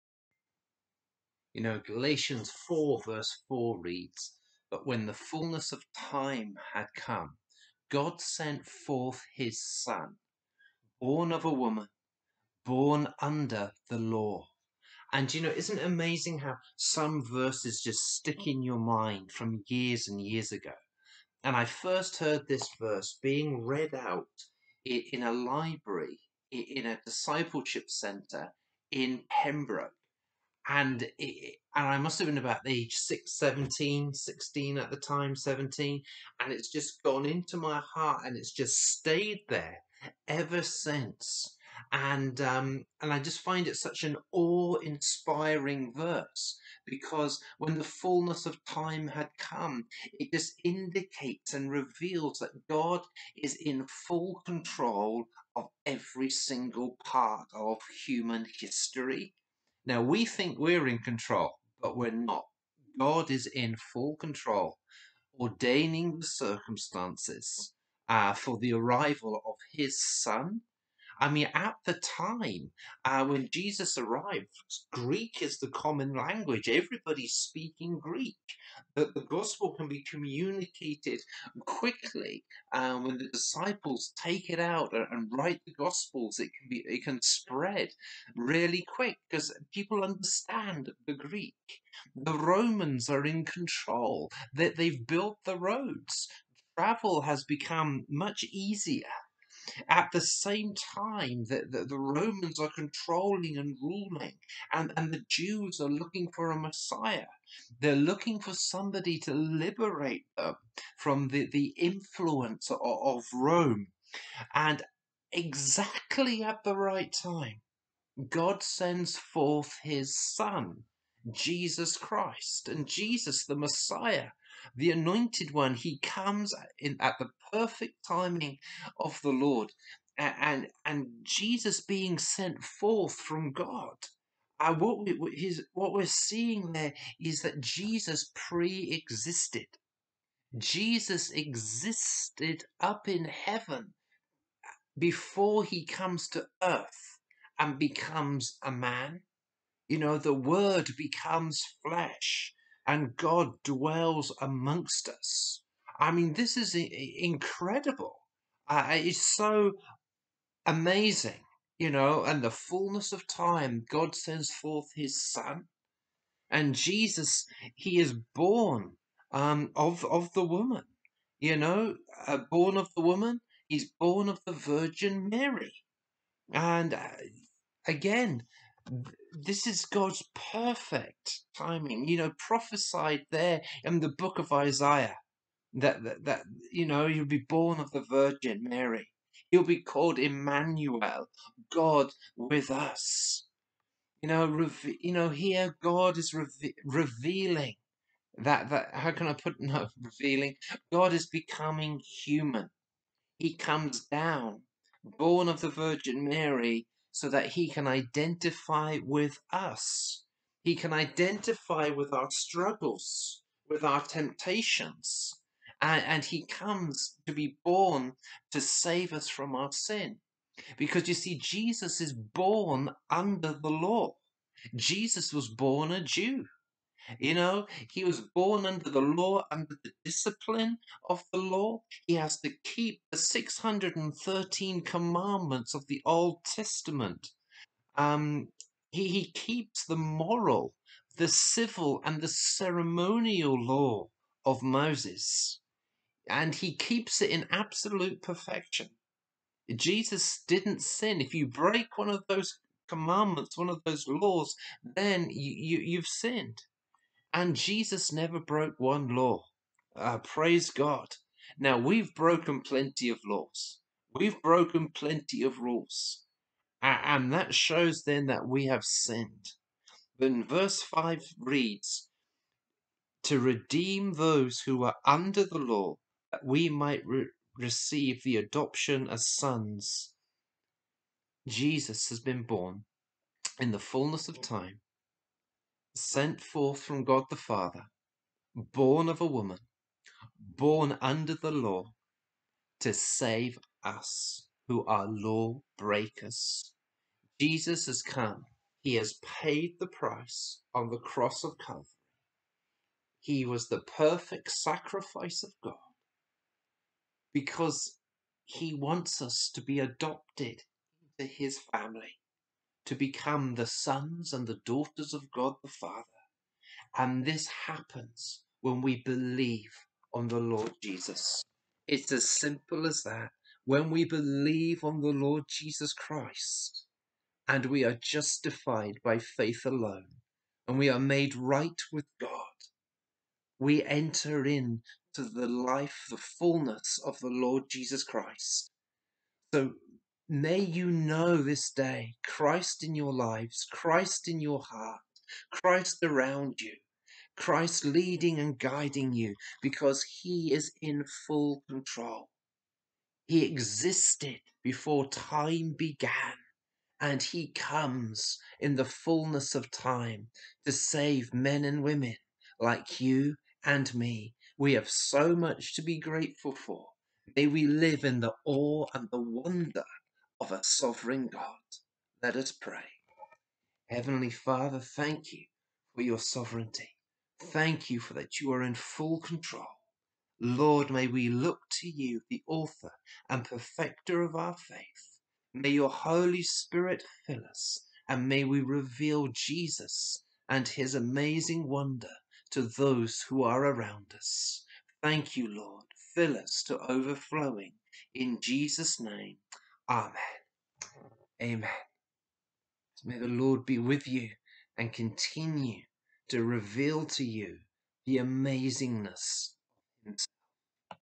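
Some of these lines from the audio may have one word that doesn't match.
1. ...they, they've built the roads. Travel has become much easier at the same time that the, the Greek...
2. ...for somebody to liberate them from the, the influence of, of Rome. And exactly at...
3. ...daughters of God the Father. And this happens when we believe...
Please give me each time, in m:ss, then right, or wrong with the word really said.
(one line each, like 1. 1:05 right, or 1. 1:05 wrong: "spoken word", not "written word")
1. 1:34 wrong: "Romans", not "Greek"
2. 1:48 right
3. 5:14 right.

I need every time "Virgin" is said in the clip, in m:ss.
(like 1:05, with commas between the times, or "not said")
2:54, 3:08, 3:25.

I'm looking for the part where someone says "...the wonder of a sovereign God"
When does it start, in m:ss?
6:09.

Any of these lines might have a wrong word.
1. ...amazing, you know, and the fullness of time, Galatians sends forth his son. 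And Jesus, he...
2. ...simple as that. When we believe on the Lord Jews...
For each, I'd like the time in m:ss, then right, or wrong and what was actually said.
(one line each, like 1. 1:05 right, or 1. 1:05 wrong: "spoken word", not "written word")
1. 2:40 wrong: "God", not "Galatians"
2. 5:22 wrong: "Jesus", not "Jews".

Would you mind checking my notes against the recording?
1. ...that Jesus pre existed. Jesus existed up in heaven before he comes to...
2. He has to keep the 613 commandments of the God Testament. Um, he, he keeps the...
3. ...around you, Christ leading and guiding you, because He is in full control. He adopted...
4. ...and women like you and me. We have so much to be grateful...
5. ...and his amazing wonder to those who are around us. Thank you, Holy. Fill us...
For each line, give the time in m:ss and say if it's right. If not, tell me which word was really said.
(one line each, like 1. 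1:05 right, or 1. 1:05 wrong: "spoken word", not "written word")
1. 2:17 right
2. 3:52 wrong: "Old", not "God"
3. 5:46 wrong: "existed", not "adopted"
4. 6:01 right
5. 6:30 wrong: "Lord", not "Holy".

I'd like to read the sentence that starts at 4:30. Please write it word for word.
Then verse 5 reads, To redeem those who are under the law, that we might re- receive the adoption as sons.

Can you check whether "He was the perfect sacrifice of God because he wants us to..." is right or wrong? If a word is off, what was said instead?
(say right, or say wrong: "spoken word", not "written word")
right.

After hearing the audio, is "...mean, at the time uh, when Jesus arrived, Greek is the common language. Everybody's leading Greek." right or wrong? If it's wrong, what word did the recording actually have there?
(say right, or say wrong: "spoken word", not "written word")
wrong: "speaking", not "leading".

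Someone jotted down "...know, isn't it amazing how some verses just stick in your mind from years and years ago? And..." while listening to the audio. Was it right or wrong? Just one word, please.
right.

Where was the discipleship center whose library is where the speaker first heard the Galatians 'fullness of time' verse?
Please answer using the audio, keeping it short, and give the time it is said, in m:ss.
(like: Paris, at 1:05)
Pembroke, at 0:29.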